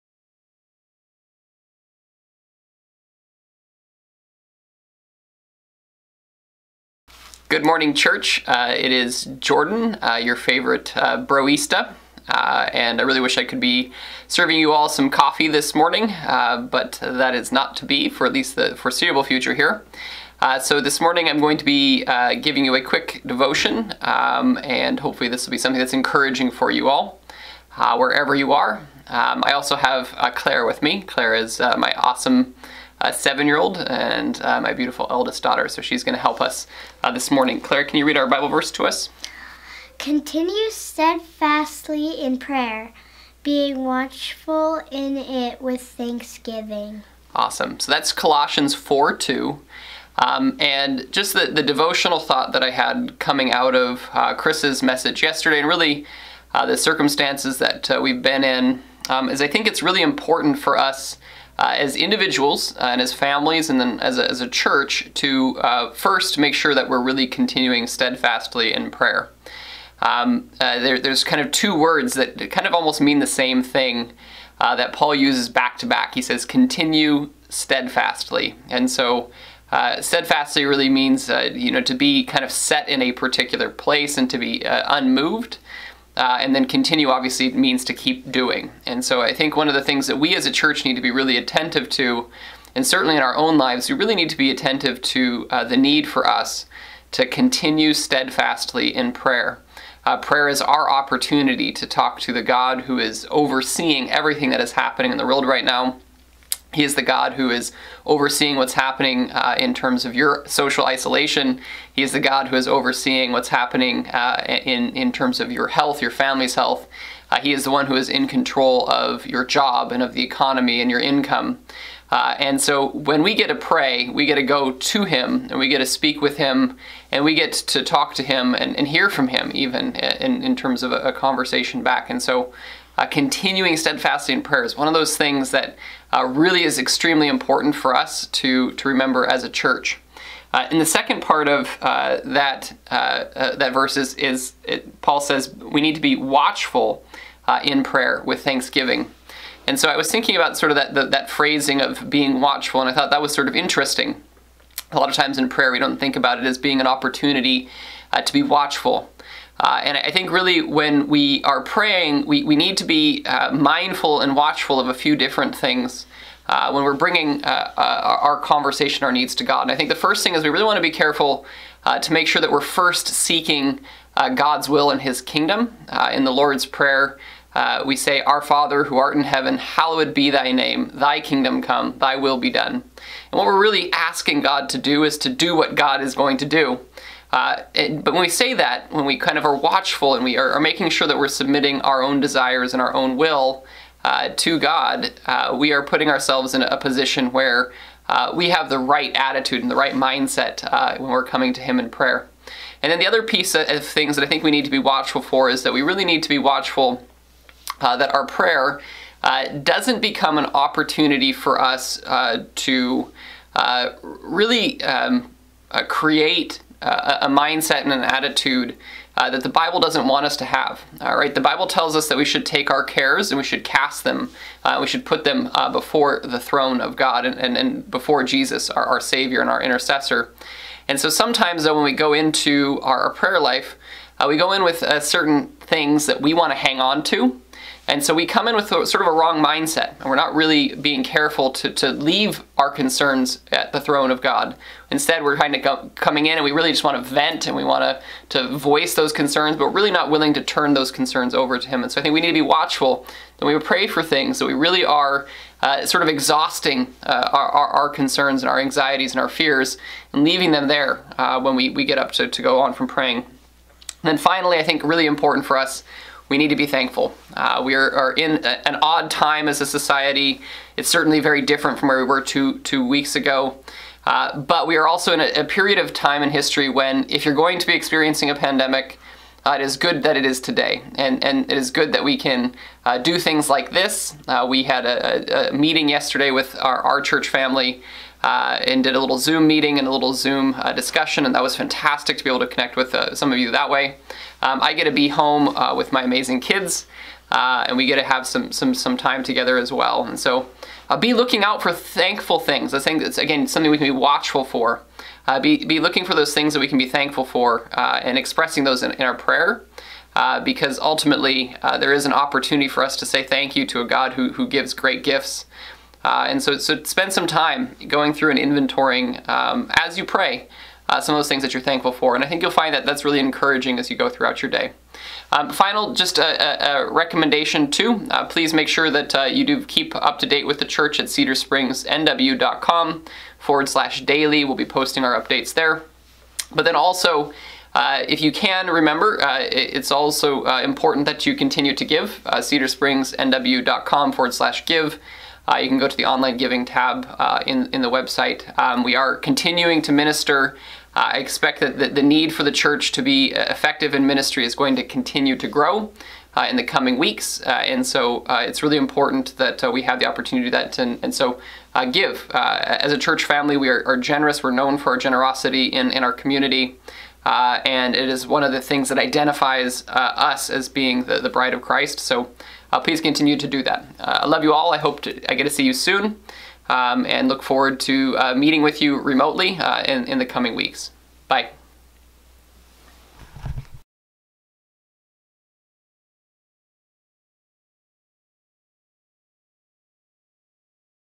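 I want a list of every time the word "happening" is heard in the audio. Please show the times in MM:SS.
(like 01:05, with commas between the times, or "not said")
01:44, 01:48, 01:53.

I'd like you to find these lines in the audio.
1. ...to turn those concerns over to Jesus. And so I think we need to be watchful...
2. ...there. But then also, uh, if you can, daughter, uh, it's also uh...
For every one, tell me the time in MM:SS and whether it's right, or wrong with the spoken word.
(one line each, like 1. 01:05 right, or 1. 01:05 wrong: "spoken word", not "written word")
1. 04:10 wrong: "Him", not "Jesus"
2. 05:35 wrong: "remember", not "daughter".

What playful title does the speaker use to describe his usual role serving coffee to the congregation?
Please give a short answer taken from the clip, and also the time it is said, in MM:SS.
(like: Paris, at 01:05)
broista, at 00:11.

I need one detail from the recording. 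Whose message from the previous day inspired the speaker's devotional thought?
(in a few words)
Chris.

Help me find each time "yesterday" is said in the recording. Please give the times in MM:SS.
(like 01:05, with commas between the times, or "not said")
00:55, 04:45.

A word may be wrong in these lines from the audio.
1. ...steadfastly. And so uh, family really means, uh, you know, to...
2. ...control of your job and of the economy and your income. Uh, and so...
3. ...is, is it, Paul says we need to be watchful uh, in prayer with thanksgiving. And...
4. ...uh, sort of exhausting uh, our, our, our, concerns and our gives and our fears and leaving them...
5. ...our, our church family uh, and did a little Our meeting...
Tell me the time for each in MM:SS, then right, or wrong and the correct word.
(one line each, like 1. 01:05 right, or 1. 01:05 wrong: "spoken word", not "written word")
1. 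01:17 wrong: "steadfastly", not "family"
2. 01:58 right
3. 02:23 right
4. 04:15 wrong: "anxieties", not "gives"
5. 04:46 wrong: "Zoom", not "Our".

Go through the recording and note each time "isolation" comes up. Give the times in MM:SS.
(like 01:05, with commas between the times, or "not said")
01:50.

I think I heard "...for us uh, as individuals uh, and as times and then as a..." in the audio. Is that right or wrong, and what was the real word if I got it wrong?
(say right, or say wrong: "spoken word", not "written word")
wrong: "families", not "times".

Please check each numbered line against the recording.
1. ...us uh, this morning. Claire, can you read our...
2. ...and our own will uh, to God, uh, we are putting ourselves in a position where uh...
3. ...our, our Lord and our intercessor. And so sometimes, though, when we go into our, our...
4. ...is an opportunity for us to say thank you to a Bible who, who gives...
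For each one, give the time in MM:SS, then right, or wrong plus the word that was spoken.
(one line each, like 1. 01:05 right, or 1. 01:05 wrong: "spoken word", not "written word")
1. 00:36 right
2. 03:12 right
3. 03:48 wrong: "Savior", not "Lord"
4. 05:11 wrong: "God", not "Bible".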